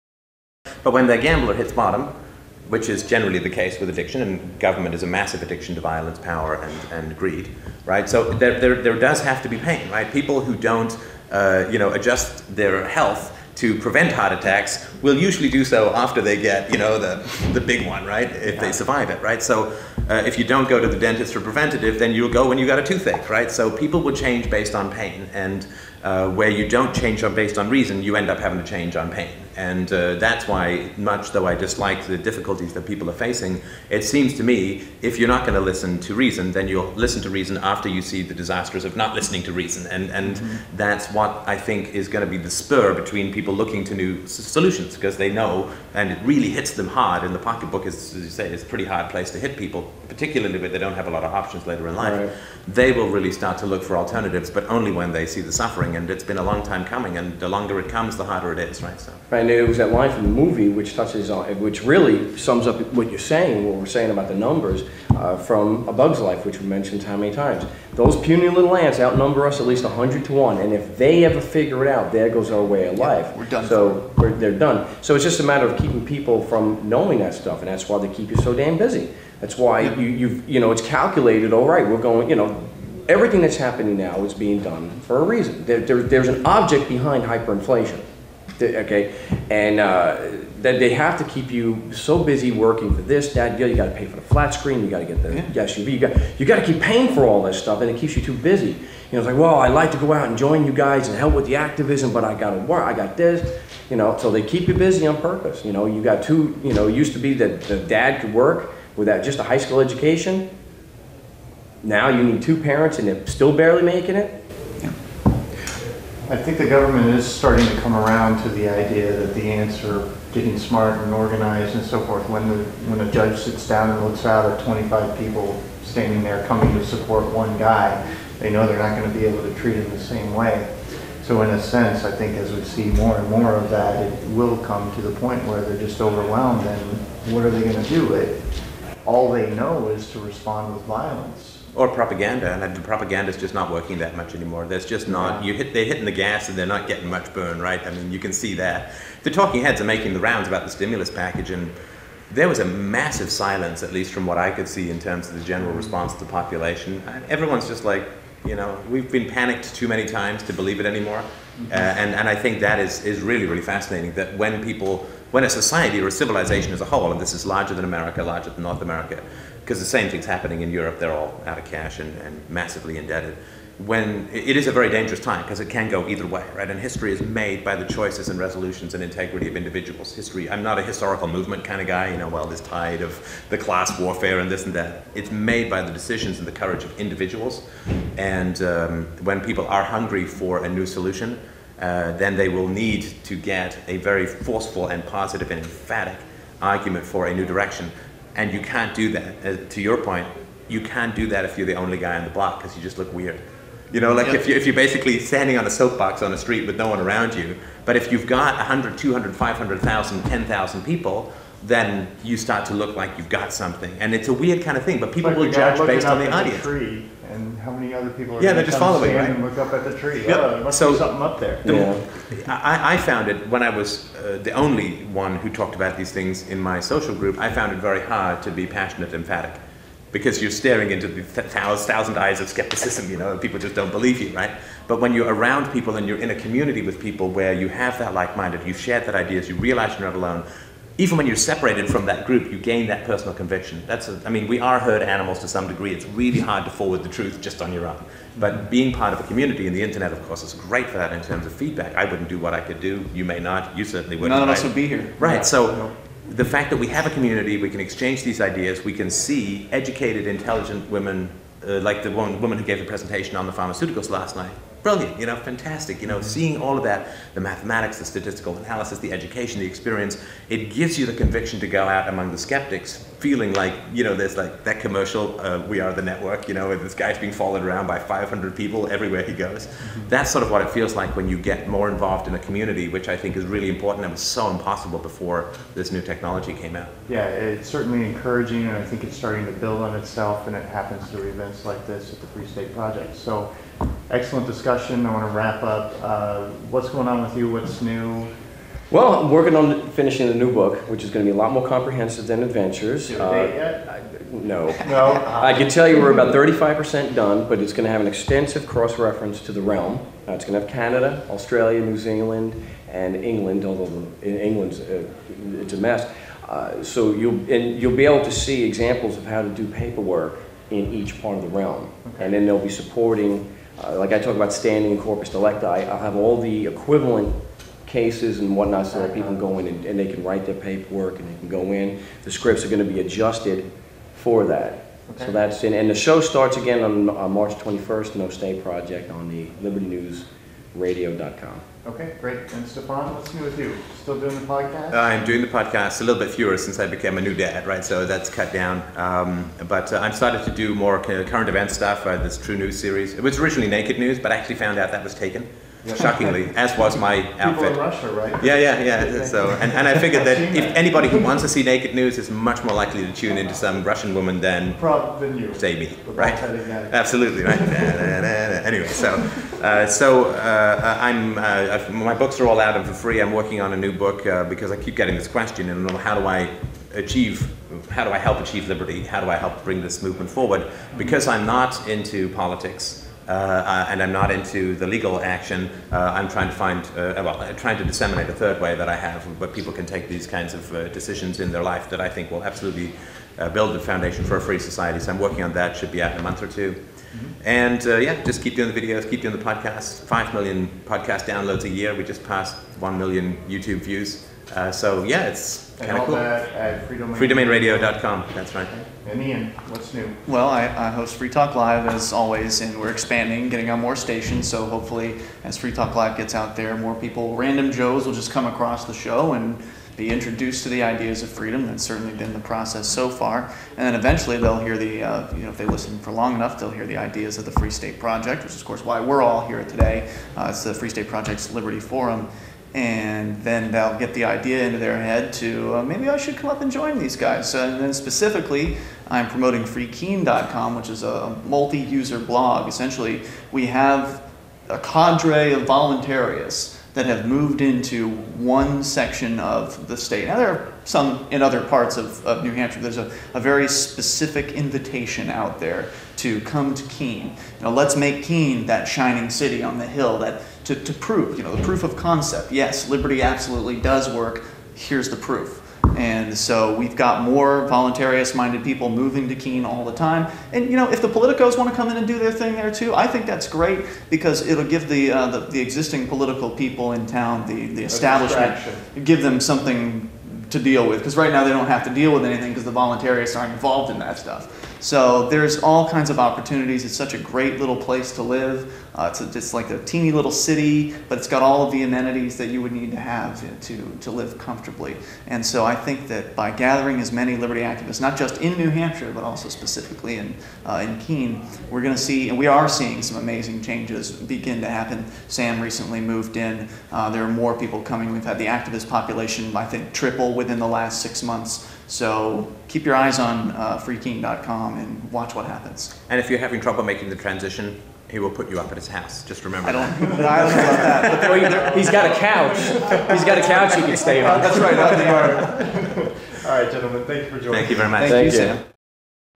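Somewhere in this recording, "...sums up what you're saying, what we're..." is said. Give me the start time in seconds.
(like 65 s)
62 s.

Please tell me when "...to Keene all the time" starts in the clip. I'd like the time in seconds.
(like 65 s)
469 s.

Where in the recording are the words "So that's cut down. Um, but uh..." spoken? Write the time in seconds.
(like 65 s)
347 s.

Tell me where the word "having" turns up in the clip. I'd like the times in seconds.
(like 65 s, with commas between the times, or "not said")
28 s, 516 s.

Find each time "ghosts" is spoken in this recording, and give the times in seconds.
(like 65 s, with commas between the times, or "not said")
not said.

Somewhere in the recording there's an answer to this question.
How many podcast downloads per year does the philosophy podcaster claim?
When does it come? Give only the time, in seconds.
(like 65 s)
400 s.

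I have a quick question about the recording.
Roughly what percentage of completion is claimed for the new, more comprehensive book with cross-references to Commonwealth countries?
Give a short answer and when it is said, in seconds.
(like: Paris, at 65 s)
35%, at 306 s.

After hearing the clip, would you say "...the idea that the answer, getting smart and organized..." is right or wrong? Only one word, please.
right.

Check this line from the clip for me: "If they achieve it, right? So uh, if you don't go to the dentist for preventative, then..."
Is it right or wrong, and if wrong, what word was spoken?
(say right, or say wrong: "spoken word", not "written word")
wrong: "survive", not "achieve".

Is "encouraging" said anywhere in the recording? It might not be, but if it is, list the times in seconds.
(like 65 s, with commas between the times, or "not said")
288 s.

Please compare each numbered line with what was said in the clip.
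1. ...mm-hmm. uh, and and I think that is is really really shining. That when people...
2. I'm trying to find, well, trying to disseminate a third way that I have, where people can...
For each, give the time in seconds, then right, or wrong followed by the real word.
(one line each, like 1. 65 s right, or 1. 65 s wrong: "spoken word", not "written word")
1. 161 s wrong: "fascinating", not "shining"
2. 385 s right.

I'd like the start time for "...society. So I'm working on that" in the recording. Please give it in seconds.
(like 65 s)
394 s.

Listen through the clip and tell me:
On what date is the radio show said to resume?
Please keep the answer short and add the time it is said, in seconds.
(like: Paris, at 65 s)
March 21st, at 337 s.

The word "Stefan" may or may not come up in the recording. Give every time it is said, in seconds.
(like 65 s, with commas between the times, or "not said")
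342 s.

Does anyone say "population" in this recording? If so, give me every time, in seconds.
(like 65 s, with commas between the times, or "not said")
156 s, 508 s.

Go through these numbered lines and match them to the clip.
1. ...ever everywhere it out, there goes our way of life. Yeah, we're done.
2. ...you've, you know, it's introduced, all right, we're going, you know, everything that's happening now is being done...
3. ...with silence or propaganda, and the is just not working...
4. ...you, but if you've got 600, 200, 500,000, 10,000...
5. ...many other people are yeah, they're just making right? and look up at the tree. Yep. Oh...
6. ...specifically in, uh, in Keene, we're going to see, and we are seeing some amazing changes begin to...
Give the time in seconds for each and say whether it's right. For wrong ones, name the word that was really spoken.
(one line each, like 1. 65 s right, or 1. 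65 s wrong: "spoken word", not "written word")
1. 71 s wrong: "figure", not "everywhere"
2. 80 s wrong: "calculated", not "introduced"
3. 140 s wrong: "violence", not "silence"
4. 207 s wrong: "100", not "600"
5. 217 s wrong: "following", not "making"
6. 499 s right.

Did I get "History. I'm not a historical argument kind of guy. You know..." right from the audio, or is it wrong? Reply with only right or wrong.
wrong.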